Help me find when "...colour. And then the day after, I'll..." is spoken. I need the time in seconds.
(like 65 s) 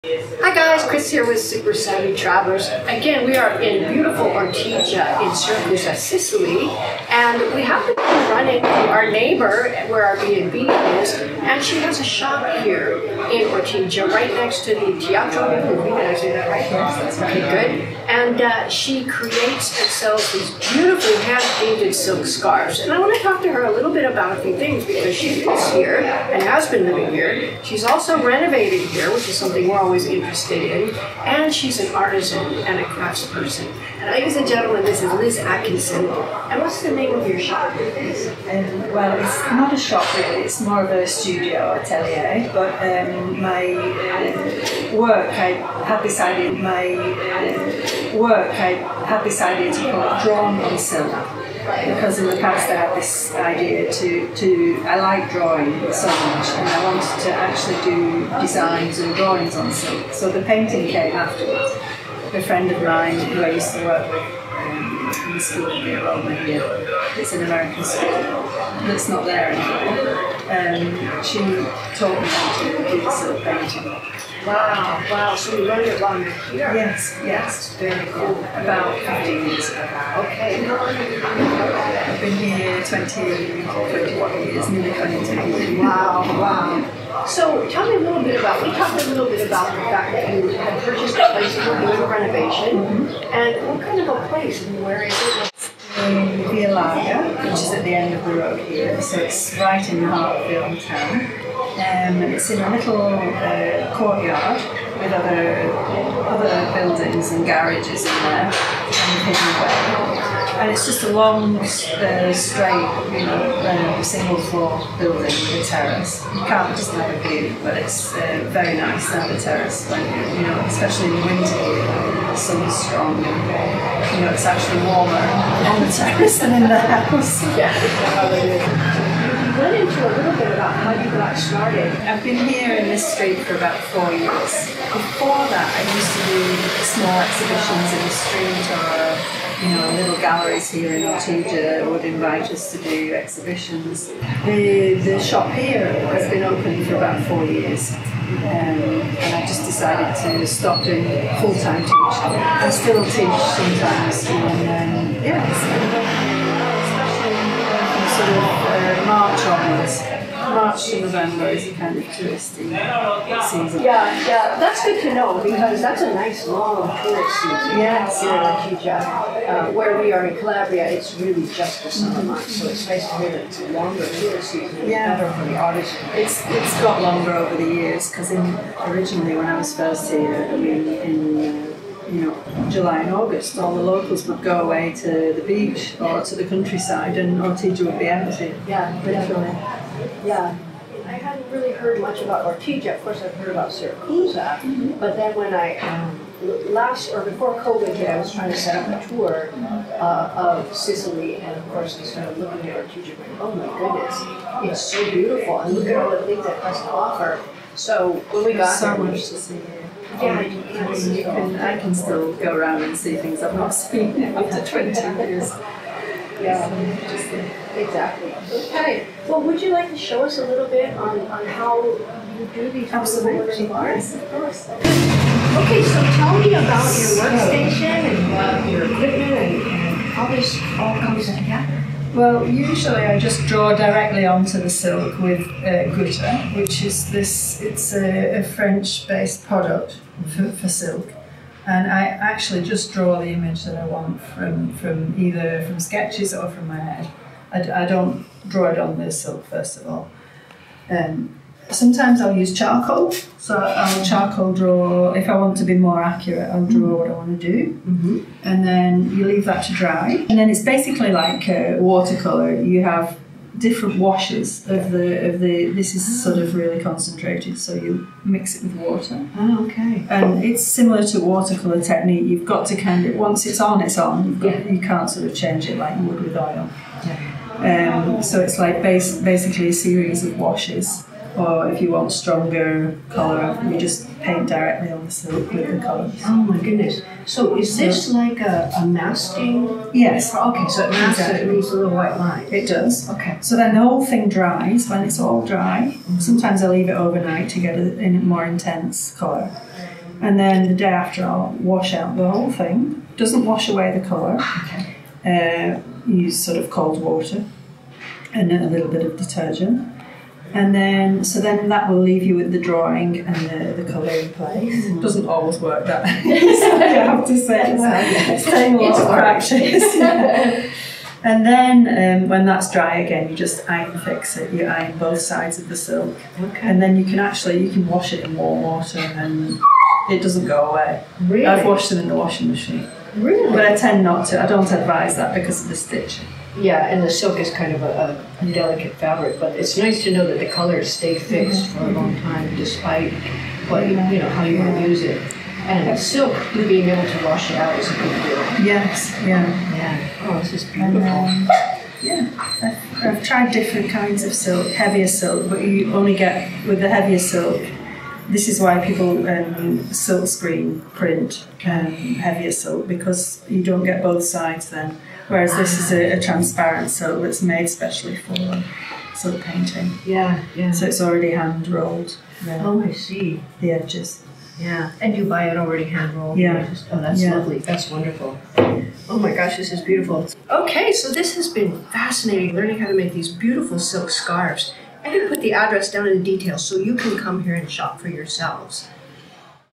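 299 s.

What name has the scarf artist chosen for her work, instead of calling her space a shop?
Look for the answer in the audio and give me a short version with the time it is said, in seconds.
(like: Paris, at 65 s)
Drawn on Silk, at 50 s.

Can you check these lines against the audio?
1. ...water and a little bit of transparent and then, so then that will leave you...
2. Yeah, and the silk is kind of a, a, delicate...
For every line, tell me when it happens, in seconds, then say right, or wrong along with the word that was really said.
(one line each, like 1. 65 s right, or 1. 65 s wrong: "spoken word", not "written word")
1. 307 s wrong: "detergent", not "transparent"
2. 336 s right.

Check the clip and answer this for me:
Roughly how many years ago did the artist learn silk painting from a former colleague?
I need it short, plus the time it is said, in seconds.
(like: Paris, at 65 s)
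15, at 78 s.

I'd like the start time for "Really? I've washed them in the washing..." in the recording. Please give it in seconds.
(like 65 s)
331 s.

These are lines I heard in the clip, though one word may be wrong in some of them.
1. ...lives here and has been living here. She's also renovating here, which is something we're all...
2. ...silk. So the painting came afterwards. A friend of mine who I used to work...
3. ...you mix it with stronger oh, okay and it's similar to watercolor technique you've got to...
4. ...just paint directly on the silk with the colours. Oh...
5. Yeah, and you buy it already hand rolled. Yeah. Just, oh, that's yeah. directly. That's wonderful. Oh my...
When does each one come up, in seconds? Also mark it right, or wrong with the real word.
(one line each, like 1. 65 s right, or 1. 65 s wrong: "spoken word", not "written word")
1. 25 s right
2. 59 s right
3. 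267 s wrong: "water", not "stronger"
4. 283 s right
5. 374 s wrong: "lovely", not "directly".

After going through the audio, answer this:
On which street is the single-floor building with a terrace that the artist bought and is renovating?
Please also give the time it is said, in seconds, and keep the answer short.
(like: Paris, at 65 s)
Via Larga, at 96 s.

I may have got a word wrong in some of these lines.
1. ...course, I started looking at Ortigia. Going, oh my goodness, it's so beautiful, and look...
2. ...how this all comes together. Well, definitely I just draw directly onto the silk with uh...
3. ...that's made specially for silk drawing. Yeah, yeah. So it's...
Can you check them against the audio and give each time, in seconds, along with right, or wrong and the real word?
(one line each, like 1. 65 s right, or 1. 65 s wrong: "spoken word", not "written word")
1. 201 s right
2. 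230 s wrong: "usually", not "definitely"
3. 367 s wrong: "painting", not "drawing".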